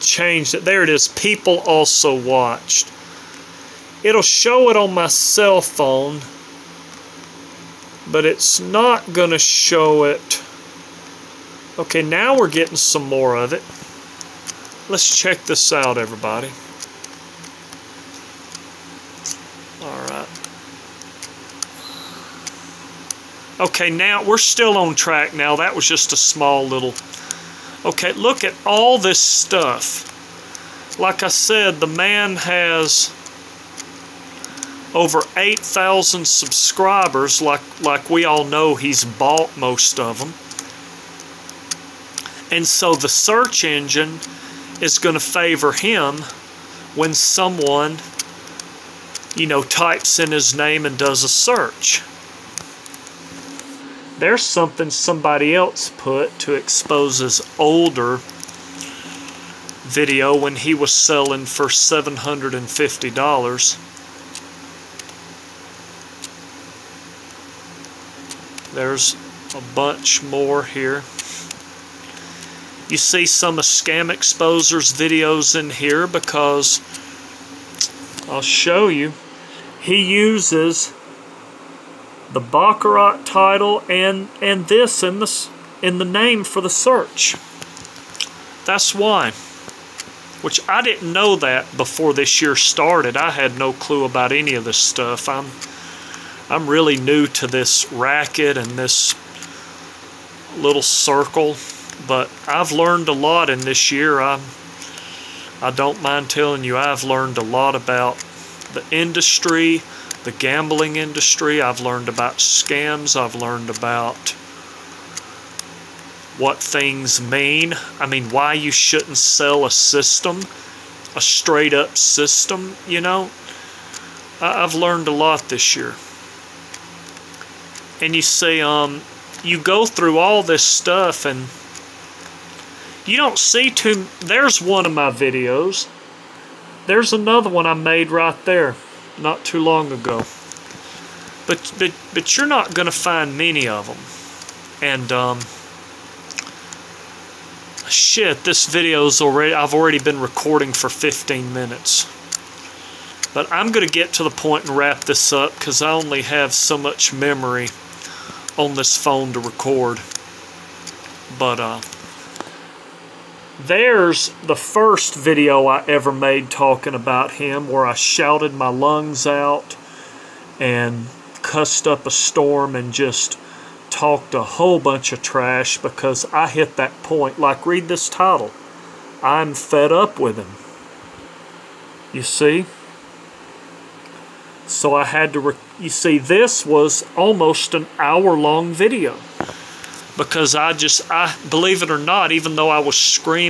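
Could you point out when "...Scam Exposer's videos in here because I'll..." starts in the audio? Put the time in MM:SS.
01:13.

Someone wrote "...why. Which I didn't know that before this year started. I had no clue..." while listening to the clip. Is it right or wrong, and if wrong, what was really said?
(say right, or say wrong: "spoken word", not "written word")
right.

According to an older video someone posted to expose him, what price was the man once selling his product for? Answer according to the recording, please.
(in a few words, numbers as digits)
$750.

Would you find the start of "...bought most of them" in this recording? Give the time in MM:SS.
00:39.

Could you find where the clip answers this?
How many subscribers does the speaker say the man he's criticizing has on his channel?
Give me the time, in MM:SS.
00:34.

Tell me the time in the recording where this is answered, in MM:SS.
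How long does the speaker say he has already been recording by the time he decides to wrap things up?
02:30.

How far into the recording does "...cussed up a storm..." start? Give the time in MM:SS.
02:51.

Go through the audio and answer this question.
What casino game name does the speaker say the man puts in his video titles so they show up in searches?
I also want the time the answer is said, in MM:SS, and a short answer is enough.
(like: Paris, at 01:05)
Baccarat, at 01:22.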